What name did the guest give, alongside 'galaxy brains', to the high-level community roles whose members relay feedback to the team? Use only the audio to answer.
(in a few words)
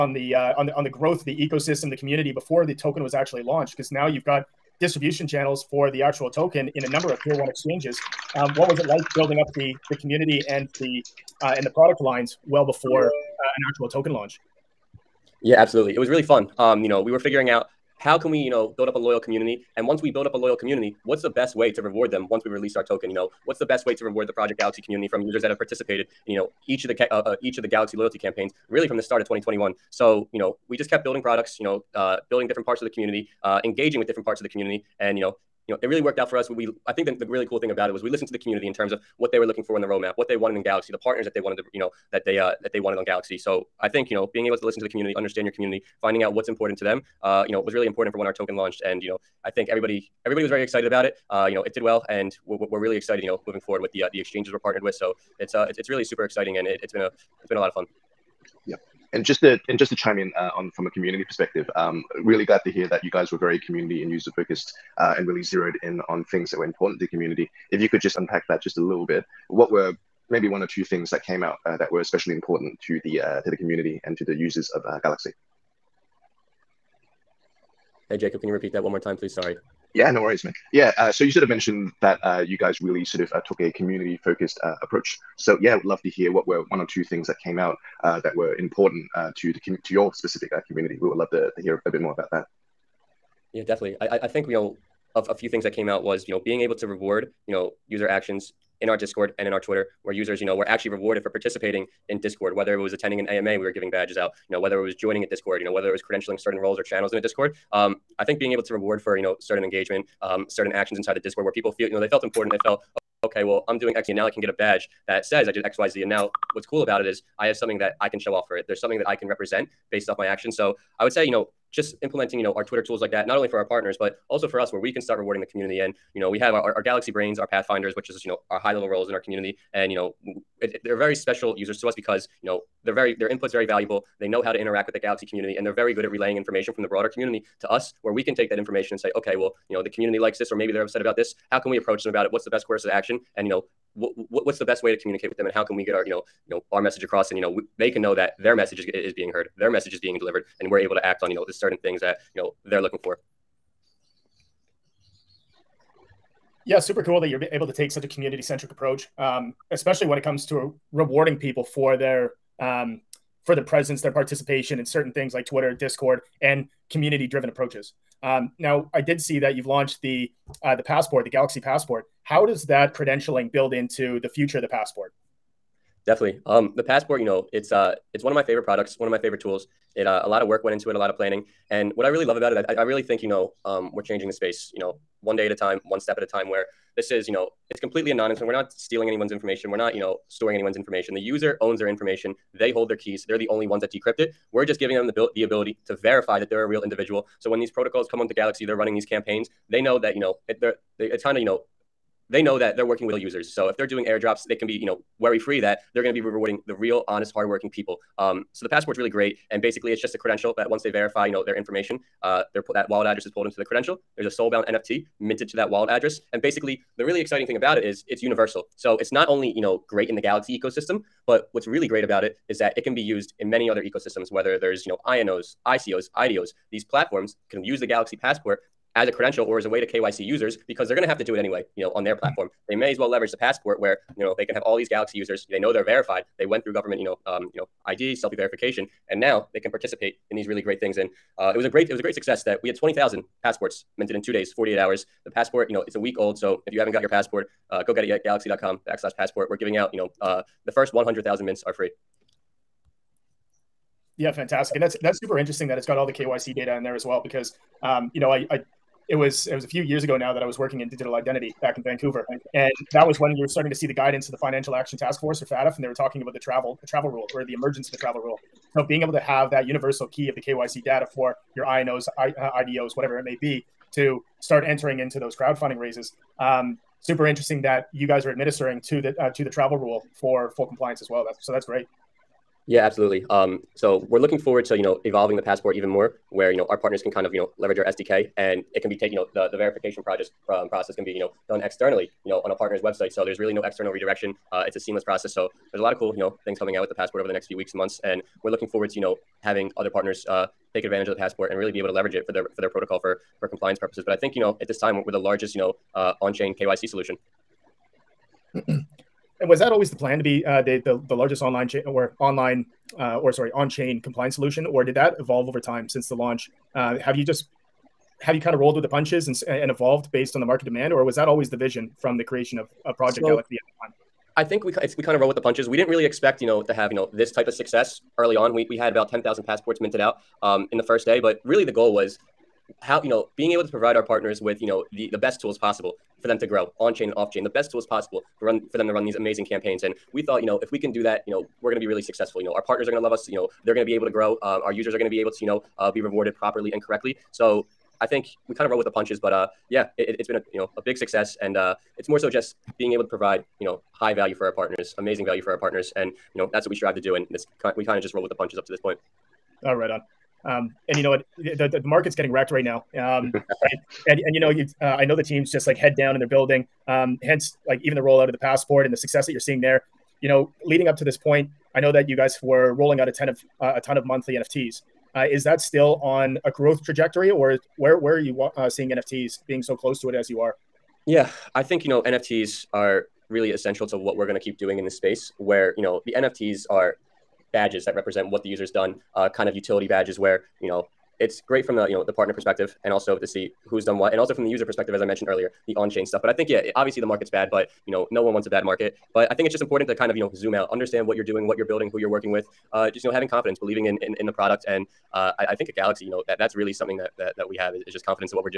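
pathfinders.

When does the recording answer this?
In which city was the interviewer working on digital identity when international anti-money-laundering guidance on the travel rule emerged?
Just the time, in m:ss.
4:21.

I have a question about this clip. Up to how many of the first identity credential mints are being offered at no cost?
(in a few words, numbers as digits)
100,000.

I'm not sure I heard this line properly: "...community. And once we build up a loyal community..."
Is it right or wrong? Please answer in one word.
right.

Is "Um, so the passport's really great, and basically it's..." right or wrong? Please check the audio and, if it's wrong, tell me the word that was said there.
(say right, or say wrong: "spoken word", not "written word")
right.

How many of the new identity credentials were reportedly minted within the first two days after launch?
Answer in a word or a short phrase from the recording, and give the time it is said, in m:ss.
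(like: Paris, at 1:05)
20,000, at 4:02.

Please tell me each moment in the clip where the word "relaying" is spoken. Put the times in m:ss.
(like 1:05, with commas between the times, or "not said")
2:16.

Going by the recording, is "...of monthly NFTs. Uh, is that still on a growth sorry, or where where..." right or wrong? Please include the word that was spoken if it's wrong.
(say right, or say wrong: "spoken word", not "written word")
wrong: "trajectory", not "sorry".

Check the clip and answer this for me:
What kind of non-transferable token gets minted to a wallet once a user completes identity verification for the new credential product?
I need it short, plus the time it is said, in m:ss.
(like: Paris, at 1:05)
soulbound NFT, at 3:34.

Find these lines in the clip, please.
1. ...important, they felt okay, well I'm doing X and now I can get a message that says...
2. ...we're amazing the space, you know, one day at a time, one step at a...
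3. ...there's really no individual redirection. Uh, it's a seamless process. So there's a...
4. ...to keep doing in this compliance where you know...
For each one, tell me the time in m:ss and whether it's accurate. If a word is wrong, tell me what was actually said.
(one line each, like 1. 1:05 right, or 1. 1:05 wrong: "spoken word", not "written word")
1. 1:52 wrong: "badge", not "message"
2. 3:03 wrong: "changing", not "amazing"
3. 4:53 wrong: "external", not "individual"
4. 6:24 wrong: "space", not "compliance".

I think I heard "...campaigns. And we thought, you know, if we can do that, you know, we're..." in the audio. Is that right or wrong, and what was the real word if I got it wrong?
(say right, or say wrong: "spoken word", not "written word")
right.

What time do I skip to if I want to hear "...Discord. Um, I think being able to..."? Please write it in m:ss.
1:47.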